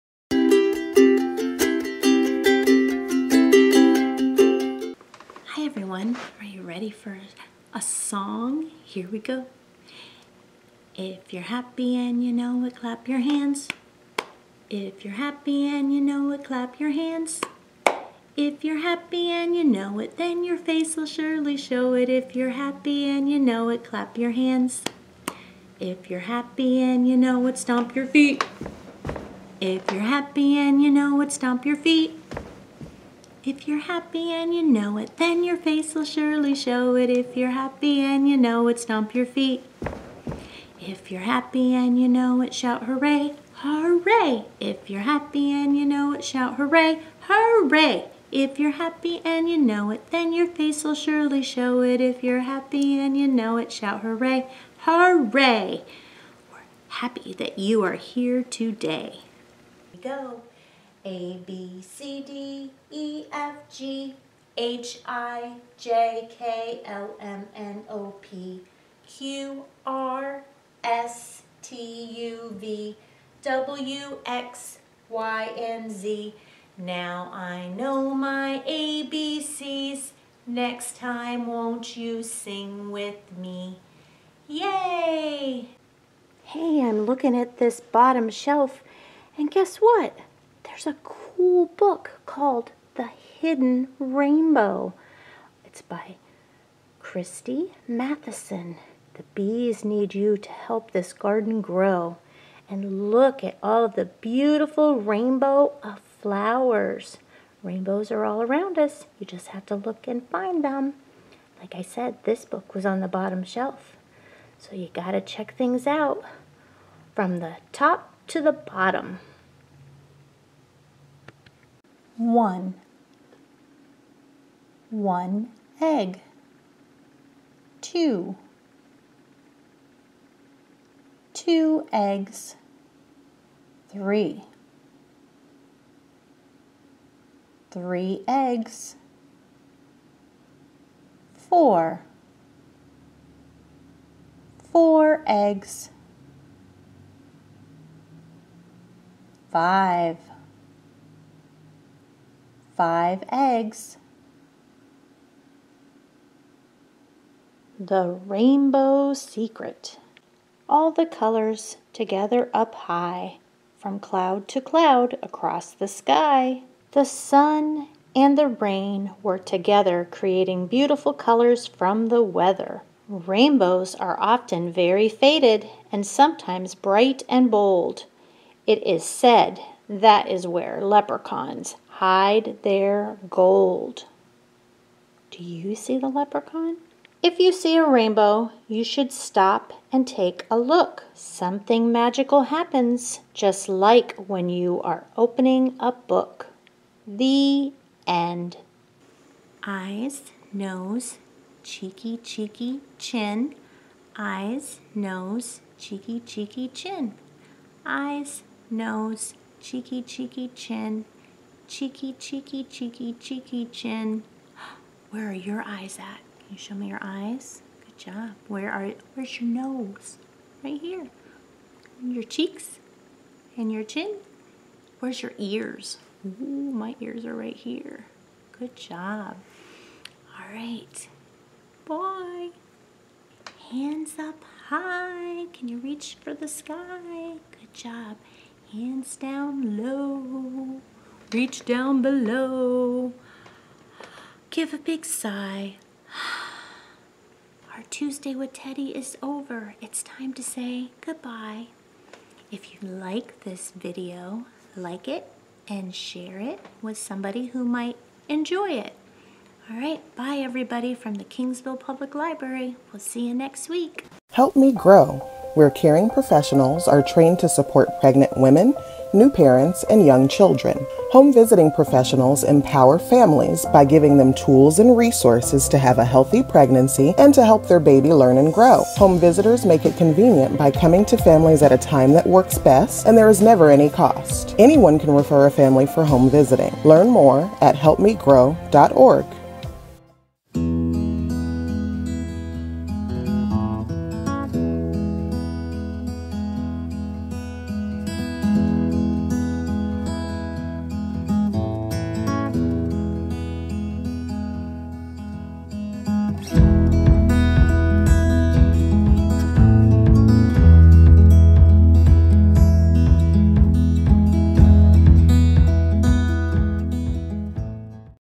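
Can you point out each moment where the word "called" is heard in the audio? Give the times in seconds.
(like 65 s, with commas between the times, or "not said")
92 s.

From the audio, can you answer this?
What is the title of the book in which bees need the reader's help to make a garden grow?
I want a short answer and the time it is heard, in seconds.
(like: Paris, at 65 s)
The Hidden Rainbow, at 92 s.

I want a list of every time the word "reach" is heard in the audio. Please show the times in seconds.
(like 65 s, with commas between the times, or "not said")
235 s, 241 s.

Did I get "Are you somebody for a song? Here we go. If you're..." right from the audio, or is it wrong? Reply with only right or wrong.
wrong.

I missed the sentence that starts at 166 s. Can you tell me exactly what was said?
The sun and the rain were together, creating beautiful colors from the weather.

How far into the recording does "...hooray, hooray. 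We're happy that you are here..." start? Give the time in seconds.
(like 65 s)
54 s.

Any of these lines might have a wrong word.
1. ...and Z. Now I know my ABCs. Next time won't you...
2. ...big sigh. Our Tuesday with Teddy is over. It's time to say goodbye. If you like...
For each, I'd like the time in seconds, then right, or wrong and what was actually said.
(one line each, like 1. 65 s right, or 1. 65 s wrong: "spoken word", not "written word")
1. 75 s right
2. 244 s right.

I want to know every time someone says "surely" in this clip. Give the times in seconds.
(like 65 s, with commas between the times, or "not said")
21 s, 36 s, 50 s.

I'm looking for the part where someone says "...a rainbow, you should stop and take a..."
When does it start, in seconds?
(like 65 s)
187 s.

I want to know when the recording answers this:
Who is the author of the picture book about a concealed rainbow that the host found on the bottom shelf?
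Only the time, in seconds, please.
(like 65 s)
96 s.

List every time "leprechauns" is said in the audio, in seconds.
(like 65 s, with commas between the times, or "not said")
180 s, 186 s.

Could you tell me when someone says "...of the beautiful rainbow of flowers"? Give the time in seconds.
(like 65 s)
103 s.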